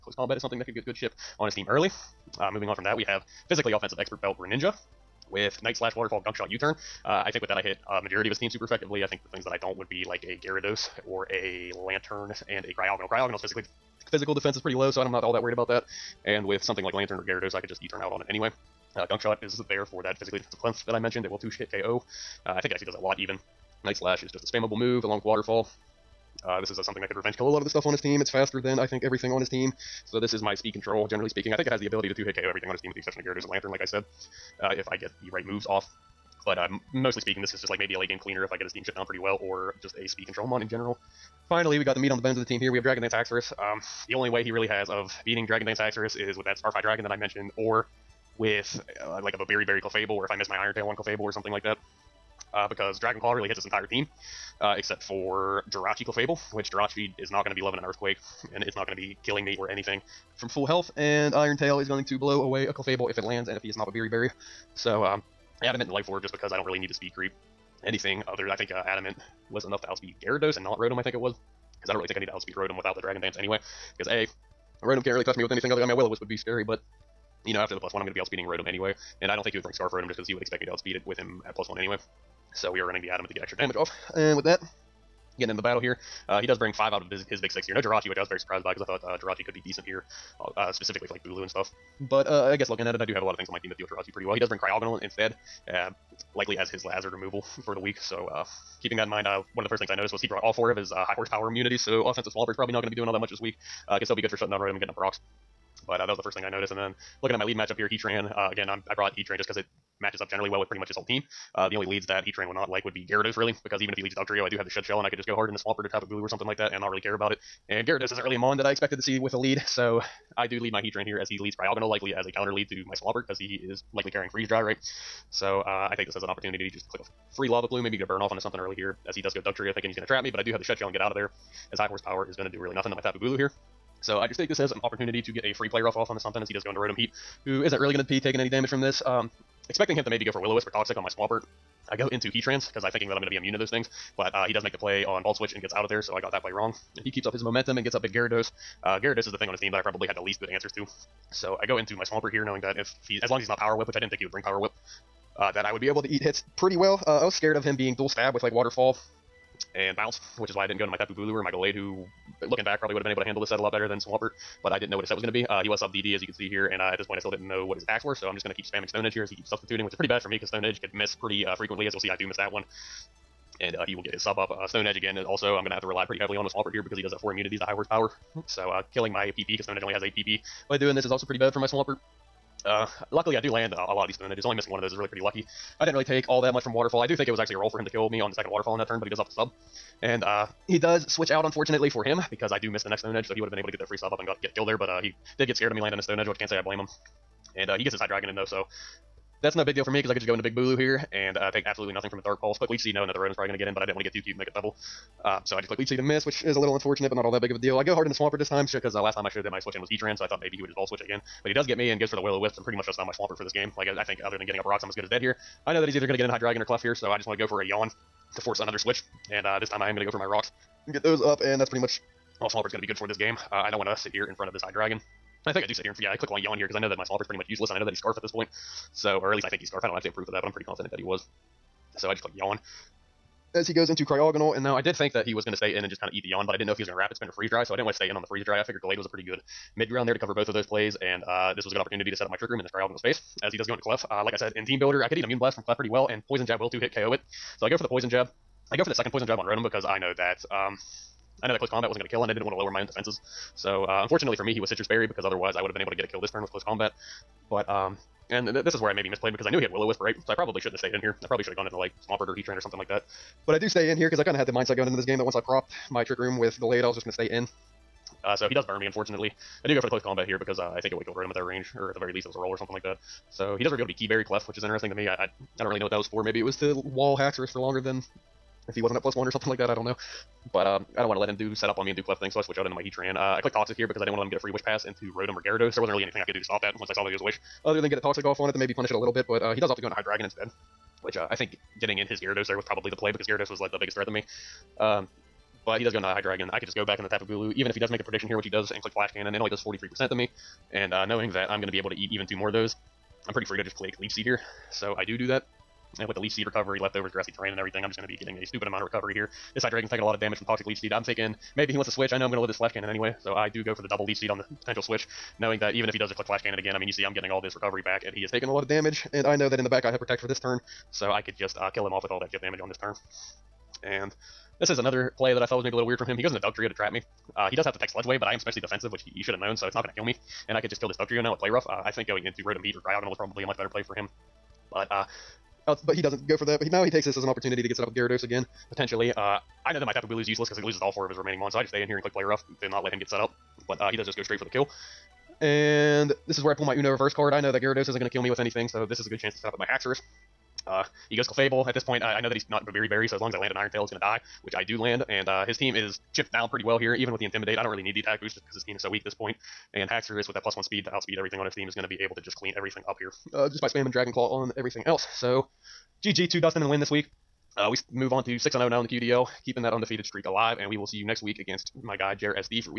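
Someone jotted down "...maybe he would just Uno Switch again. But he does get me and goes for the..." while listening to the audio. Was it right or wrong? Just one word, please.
wrong.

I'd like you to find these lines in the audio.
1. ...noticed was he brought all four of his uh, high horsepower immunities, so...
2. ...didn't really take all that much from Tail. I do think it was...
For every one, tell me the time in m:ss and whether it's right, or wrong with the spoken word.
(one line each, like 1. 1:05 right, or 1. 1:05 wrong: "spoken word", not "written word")
1. 1:39 right
2. 3:05 wrong: "Waterfall", not "Tail".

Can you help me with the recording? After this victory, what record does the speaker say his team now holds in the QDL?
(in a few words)
6-0.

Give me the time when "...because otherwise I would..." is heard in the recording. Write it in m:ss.
4:15.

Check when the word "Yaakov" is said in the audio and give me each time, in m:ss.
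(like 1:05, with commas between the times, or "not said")
not said.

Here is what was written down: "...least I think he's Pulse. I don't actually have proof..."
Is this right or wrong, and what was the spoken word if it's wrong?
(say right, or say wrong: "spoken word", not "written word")
wrong: "Scarf", not "Pulse".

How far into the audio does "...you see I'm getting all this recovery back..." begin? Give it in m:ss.
5:16.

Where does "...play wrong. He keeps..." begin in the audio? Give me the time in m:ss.
2:26.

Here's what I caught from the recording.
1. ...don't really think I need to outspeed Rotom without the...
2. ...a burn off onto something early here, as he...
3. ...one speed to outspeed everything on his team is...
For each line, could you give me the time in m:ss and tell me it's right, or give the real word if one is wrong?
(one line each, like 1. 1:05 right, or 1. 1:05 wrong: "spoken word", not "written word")
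1. 1:11 right
2. 2:08 right
3. 6:00 right.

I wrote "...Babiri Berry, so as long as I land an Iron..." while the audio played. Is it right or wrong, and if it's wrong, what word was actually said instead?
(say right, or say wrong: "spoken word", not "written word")
right.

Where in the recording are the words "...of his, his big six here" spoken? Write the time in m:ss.
1:27.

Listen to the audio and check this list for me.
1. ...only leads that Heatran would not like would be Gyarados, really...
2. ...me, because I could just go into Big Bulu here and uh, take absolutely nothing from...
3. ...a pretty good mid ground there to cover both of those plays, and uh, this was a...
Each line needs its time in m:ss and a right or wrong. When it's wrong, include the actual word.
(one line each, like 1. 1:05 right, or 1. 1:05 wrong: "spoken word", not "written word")
1. 1:51 right
2. 3:19 right
3. 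3:59 right.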